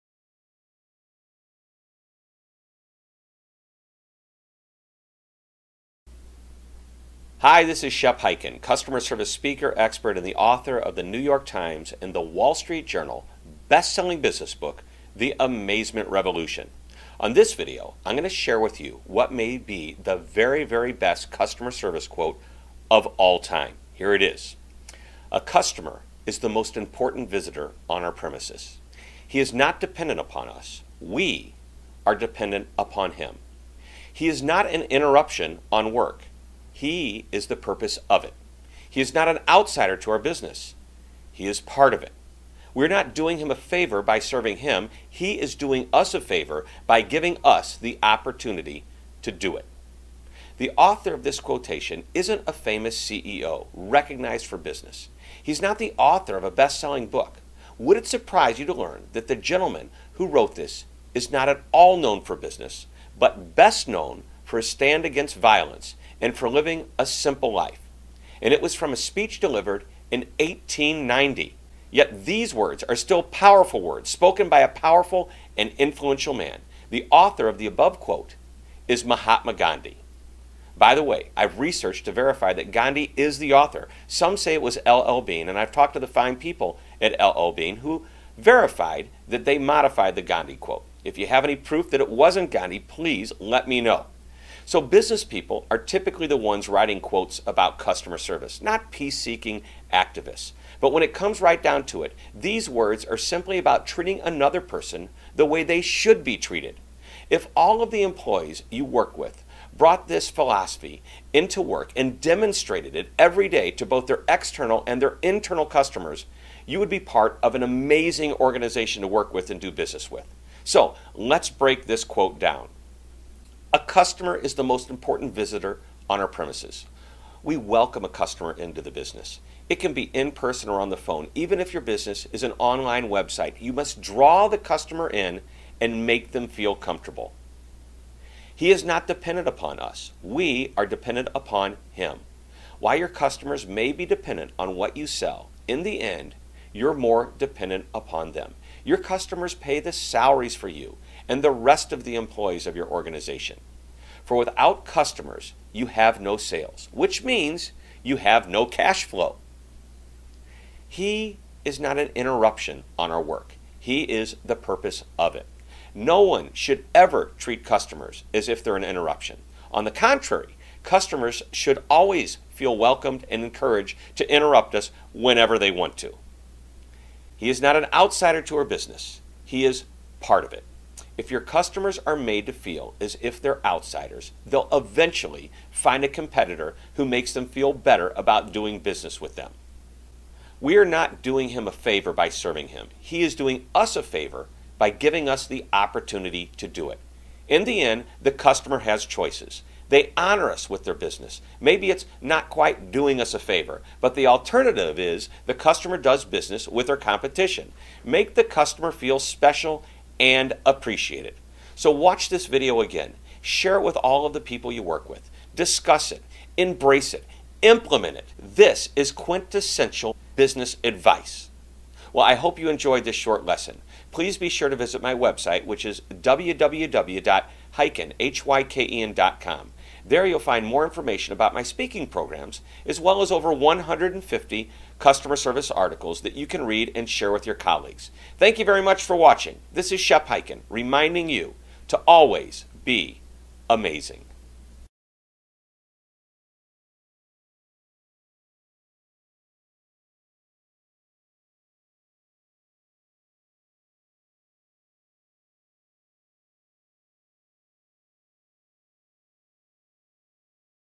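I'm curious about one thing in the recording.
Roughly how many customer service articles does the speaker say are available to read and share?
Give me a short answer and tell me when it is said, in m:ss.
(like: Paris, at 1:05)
over 150, at 3:53.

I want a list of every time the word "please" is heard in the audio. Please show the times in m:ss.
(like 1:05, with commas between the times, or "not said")
1:32, 3:44.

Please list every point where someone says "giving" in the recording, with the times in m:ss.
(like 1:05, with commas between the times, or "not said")
0:47, 3:14.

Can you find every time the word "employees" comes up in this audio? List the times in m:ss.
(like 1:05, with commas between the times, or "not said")
1:48, 2:32.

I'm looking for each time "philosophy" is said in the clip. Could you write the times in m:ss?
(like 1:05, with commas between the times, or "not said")
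1:50.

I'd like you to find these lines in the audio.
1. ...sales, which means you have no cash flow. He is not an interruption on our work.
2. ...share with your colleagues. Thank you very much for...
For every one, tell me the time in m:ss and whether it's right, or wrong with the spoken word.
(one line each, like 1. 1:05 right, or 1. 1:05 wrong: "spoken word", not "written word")
1. 2:36 right
2. 3:57 right.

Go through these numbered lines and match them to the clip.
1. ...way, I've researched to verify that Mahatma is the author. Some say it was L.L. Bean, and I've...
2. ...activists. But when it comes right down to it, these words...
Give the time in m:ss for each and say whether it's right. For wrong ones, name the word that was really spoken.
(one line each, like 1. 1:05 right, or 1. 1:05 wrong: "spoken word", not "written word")
1. 1:21 wrong: "Gandhi", not "Mahatma"
2. 1:39 right.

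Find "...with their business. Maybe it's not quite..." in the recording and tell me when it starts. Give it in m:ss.
3:20.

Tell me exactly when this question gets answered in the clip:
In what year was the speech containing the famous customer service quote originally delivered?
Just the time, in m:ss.
1:10.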